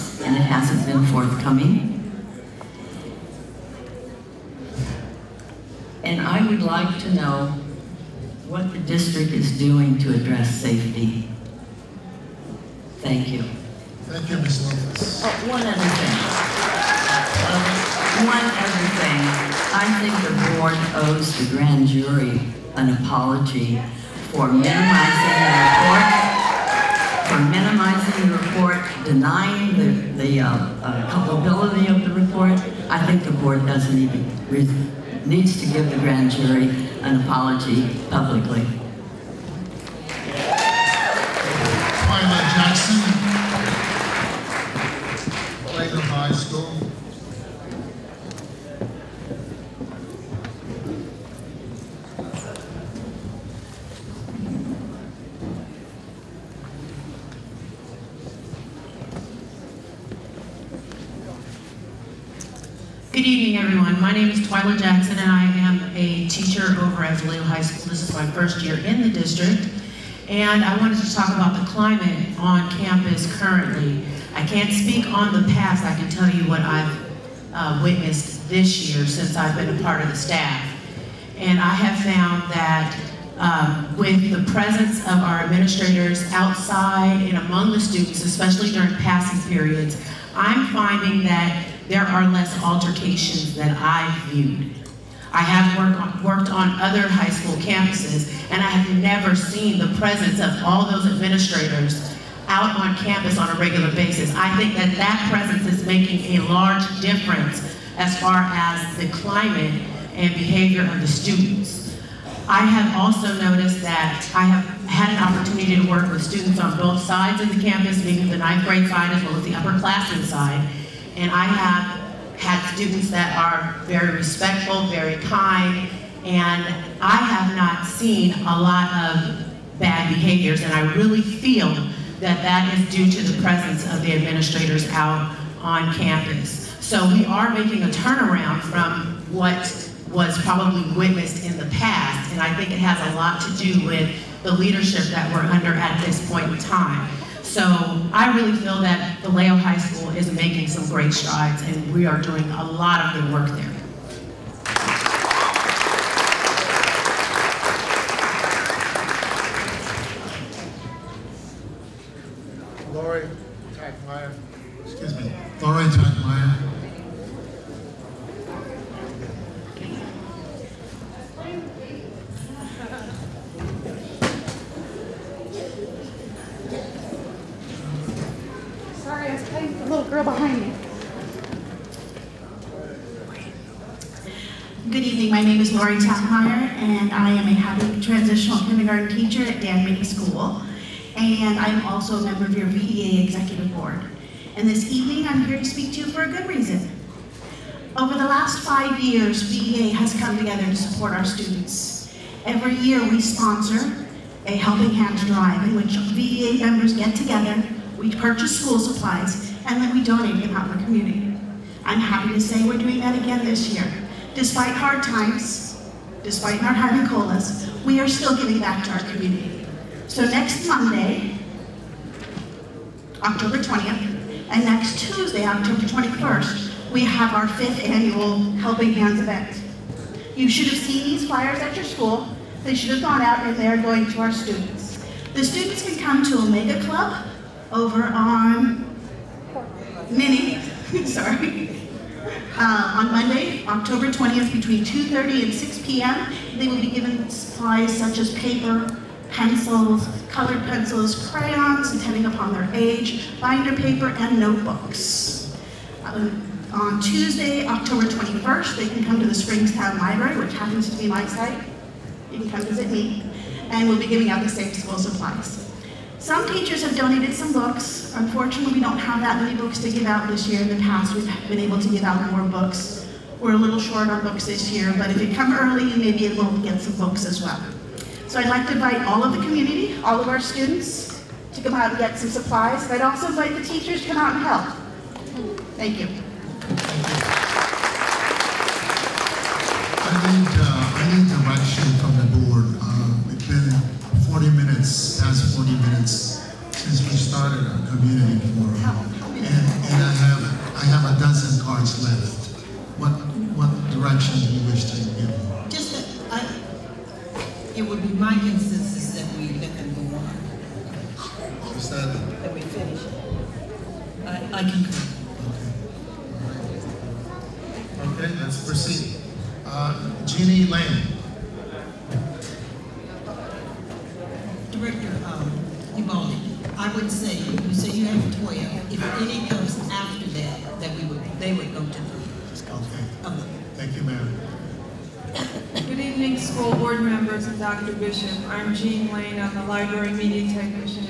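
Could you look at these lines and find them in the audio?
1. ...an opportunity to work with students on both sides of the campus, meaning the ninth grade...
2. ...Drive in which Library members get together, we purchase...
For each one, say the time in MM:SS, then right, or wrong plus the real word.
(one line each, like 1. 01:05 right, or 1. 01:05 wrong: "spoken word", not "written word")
1. 01:55 right
2. 03:25 wrong: "VEA", not "Library".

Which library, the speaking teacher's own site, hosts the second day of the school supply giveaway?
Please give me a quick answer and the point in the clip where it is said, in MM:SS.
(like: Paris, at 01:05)
Springstown Library, at 04:19.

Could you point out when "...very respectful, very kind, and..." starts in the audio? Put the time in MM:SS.
02:03.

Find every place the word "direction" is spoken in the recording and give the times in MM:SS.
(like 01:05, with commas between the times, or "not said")
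04:51, 05:03.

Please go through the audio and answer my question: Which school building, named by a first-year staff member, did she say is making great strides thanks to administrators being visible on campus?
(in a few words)
Vallejo High School.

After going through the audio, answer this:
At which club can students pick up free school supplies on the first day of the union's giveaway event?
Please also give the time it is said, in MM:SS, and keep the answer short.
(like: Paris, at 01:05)
Omega Club, at 03:56.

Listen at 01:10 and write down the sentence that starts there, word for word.
And I wanted to talk about the climate on campus currently.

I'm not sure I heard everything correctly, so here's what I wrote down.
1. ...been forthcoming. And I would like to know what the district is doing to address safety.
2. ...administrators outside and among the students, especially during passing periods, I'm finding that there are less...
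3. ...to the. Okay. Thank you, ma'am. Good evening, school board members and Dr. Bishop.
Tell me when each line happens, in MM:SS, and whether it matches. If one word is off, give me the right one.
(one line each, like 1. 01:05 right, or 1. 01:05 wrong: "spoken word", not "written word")
1. 00:00 right
2. 01:25 right
3. 05:31 right.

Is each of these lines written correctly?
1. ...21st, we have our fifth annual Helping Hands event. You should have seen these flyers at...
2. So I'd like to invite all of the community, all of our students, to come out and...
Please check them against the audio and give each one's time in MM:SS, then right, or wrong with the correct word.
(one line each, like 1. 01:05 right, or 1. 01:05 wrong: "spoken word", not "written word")
1. 03:45 right
2. 04:38 right.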